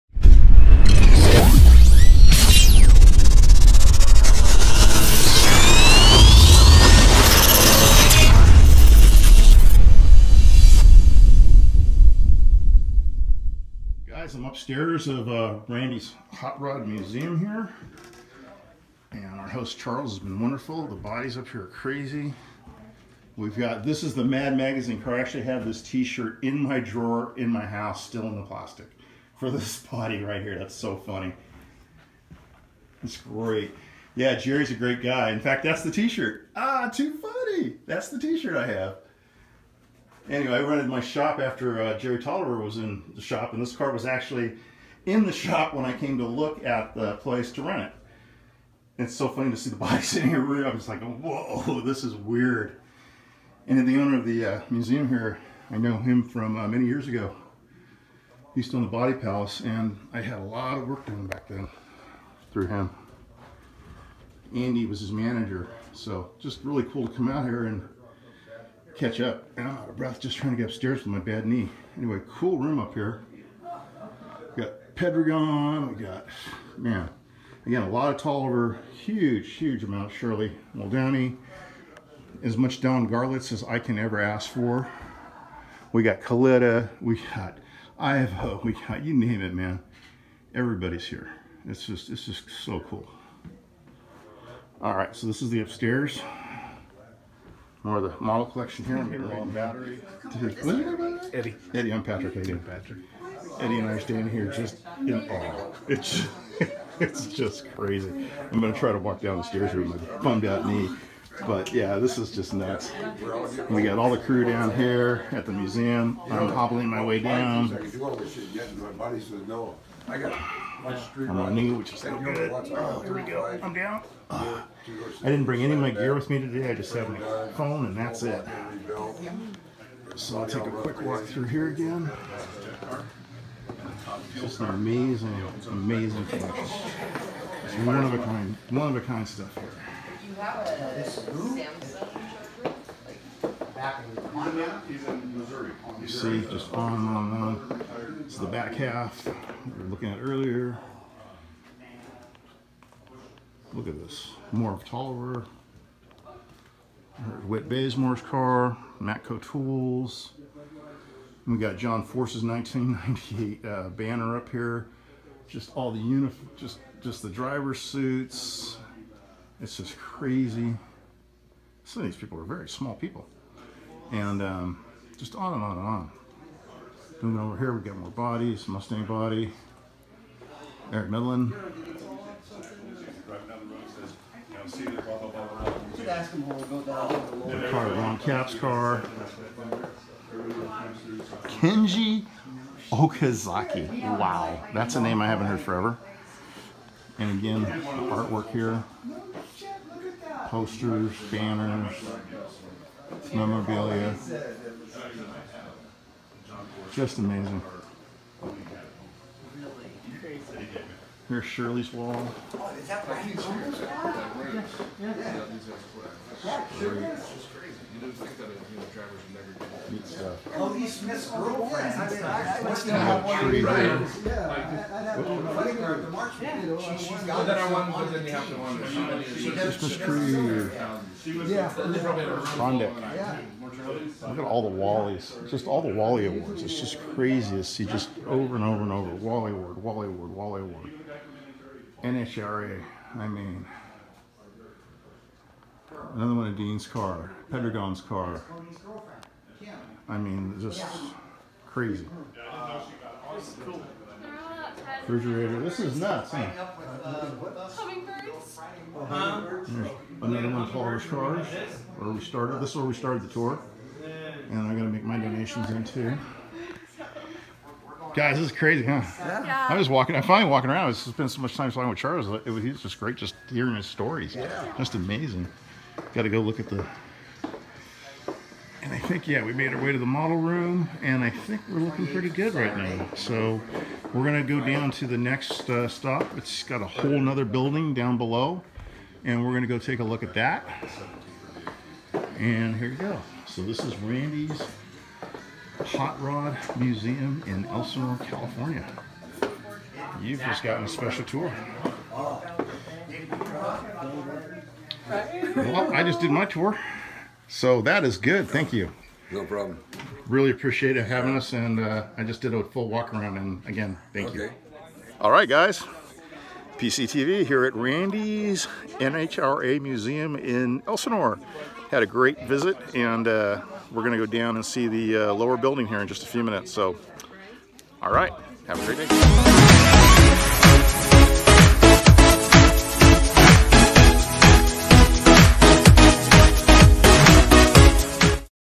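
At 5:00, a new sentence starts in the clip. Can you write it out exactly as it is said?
You've just gotten a special tour.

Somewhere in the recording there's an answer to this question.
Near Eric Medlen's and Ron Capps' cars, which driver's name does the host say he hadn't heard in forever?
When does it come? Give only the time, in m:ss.
3:11.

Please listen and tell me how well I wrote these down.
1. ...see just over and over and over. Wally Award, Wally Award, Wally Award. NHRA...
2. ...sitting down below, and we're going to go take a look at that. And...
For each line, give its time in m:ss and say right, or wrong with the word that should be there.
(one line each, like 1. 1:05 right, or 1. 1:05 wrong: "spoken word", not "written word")
1. 3:57 right
2. 4:47 wrong: "building", not "sitting".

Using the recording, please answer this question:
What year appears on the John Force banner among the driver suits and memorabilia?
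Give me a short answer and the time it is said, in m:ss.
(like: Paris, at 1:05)
1998, at 2:42.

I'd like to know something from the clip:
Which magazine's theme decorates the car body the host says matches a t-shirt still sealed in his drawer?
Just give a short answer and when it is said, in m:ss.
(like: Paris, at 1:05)
Mad Magazine, at 0:24.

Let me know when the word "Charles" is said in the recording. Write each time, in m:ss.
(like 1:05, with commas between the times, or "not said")
0:19, 4:31.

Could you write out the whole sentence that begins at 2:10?
So I'll take a quick walk through here again.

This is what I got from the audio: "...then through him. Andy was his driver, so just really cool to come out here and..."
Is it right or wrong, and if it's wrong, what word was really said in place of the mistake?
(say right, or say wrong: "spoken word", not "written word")
wrong: "manager", not "driver".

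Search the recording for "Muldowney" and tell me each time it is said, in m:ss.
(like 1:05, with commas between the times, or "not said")
1:20.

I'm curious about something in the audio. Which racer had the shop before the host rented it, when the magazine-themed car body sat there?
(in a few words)
Jerry Toliver.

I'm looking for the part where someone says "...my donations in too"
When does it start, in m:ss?
4:25.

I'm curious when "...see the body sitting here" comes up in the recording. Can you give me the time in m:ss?
0:49.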